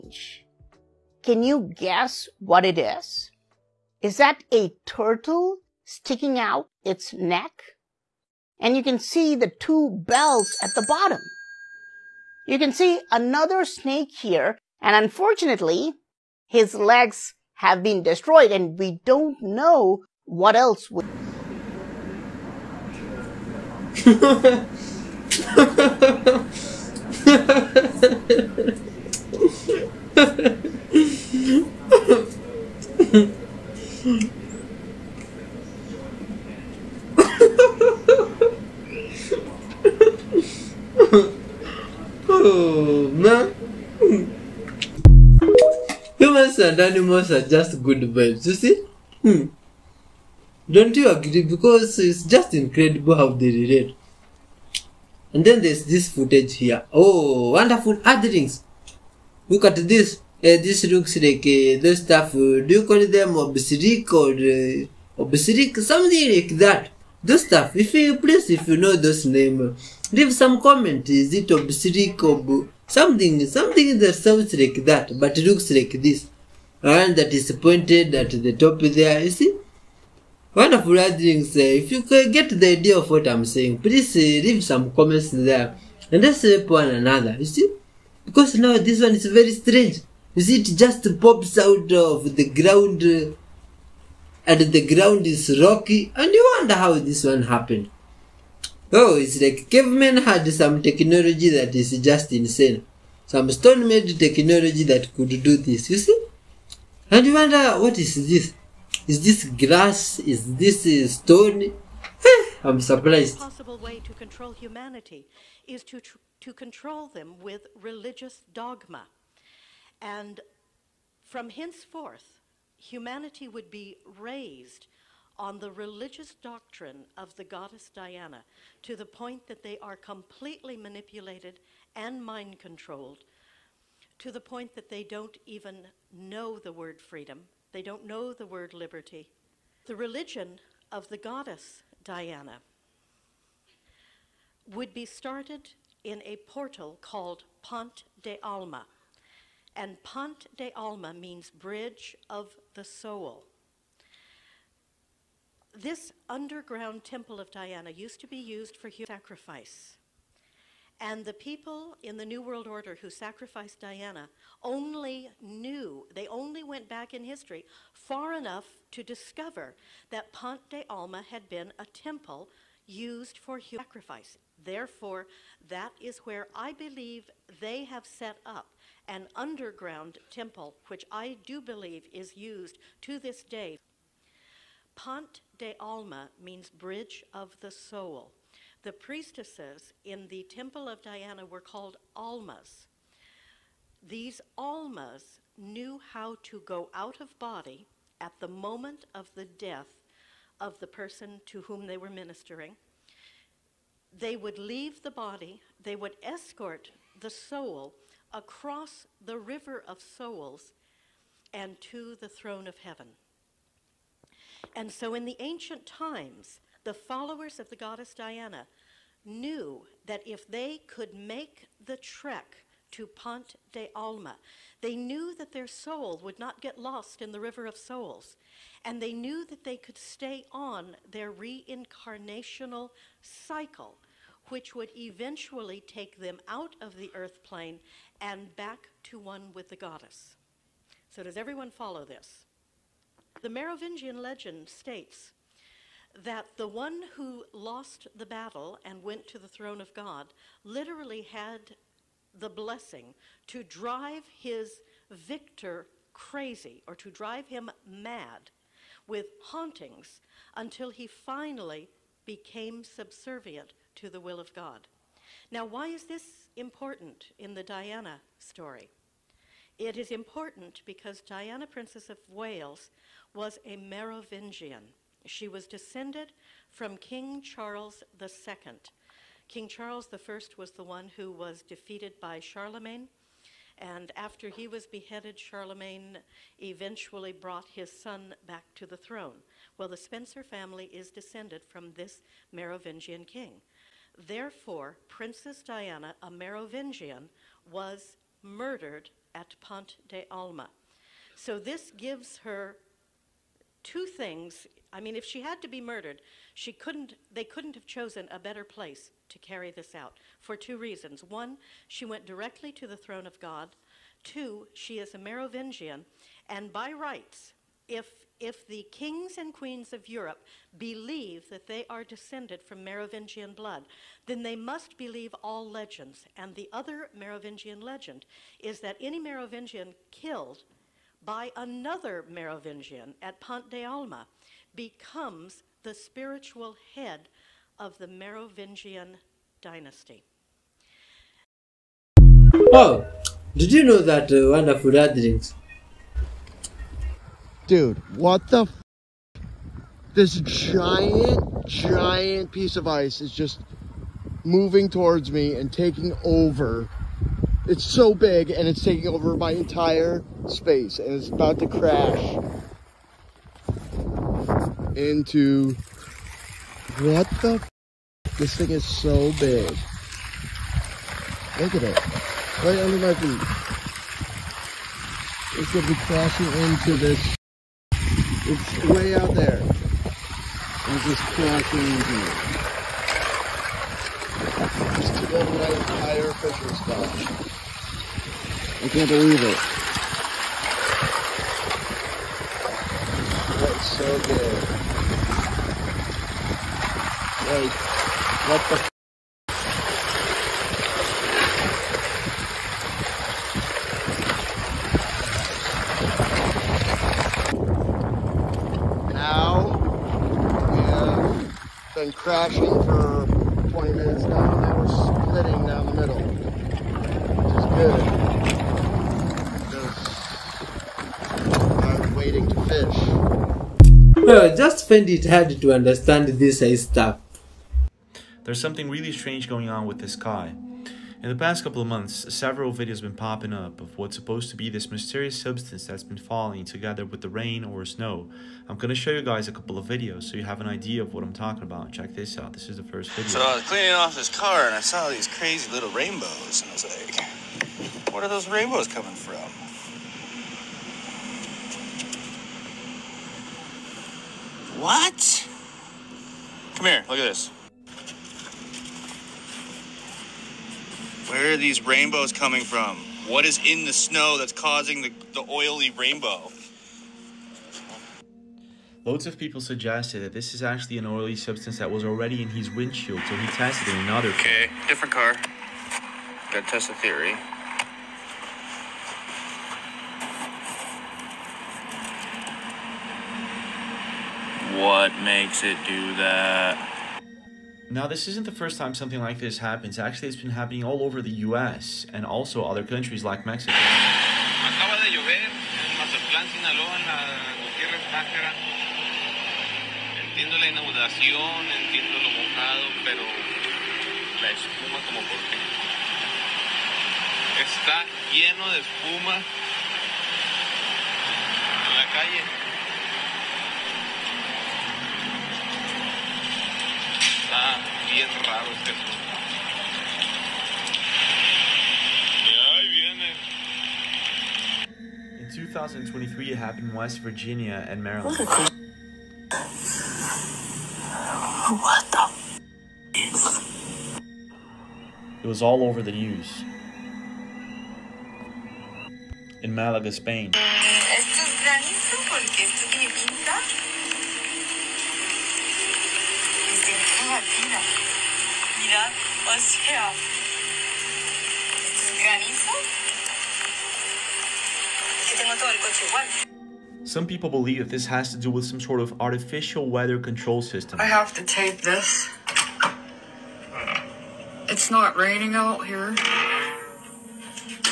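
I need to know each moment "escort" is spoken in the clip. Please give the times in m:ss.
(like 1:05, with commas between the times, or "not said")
3:26.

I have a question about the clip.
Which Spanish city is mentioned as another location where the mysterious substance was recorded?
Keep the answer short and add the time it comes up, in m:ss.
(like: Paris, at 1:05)
Malaga, at 8:59.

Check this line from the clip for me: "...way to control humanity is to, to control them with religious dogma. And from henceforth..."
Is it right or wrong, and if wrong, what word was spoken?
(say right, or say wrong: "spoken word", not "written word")
right.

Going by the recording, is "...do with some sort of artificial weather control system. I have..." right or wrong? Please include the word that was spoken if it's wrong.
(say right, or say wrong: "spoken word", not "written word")
right.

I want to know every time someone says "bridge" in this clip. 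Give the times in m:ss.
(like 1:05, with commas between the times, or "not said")
2:31, 3:06.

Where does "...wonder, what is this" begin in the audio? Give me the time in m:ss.
1:47.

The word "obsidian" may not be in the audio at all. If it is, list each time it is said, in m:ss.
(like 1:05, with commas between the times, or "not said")
1:03, 1:11.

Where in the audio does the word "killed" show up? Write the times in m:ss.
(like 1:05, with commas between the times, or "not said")
5:30.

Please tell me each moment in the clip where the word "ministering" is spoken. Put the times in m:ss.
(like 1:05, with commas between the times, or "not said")
3:22.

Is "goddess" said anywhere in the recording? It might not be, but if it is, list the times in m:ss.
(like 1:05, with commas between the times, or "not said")
2:07, 2:21, 3:37, 3:59.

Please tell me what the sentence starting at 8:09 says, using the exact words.
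Actually, it's been happening all over the US and also other countries like Mexico.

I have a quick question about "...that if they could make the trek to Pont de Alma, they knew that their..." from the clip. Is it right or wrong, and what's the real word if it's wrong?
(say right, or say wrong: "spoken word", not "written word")
right.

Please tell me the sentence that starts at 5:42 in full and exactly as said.
Oh, did you know that uh, wonderful drinks?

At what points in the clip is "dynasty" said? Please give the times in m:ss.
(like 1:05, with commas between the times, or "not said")
5:39.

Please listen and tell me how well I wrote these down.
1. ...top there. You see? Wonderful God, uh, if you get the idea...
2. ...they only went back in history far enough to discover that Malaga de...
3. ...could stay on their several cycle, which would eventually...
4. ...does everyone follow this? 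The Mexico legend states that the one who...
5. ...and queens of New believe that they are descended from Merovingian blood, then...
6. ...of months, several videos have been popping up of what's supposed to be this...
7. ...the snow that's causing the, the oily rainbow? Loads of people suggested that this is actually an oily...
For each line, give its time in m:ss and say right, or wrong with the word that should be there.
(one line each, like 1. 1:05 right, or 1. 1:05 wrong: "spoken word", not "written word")
1. 1:18 wrong: "Earthlings", not "God"
2. 2:46 wrong: "Ponte", not "Malaga"
3. 3:49 wrong: "reincarnational", not "several"
4. 4:01 wrong: "Merovingian", not "Mexico"
5. 5:19 wrong: "Europe", not "New"
6. 7:11 right
7. 7:43 right.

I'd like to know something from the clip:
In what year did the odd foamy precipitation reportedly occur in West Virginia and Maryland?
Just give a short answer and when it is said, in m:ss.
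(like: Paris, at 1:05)
2023, at 8:45.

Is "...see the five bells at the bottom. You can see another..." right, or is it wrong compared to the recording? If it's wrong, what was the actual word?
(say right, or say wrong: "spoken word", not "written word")
wrong: "two", not "five".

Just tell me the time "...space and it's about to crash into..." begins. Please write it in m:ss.
6:00.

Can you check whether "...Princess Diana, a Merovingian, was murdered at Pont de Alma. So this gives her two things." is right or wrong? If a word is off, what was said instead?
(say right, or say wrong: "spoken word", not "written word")
right.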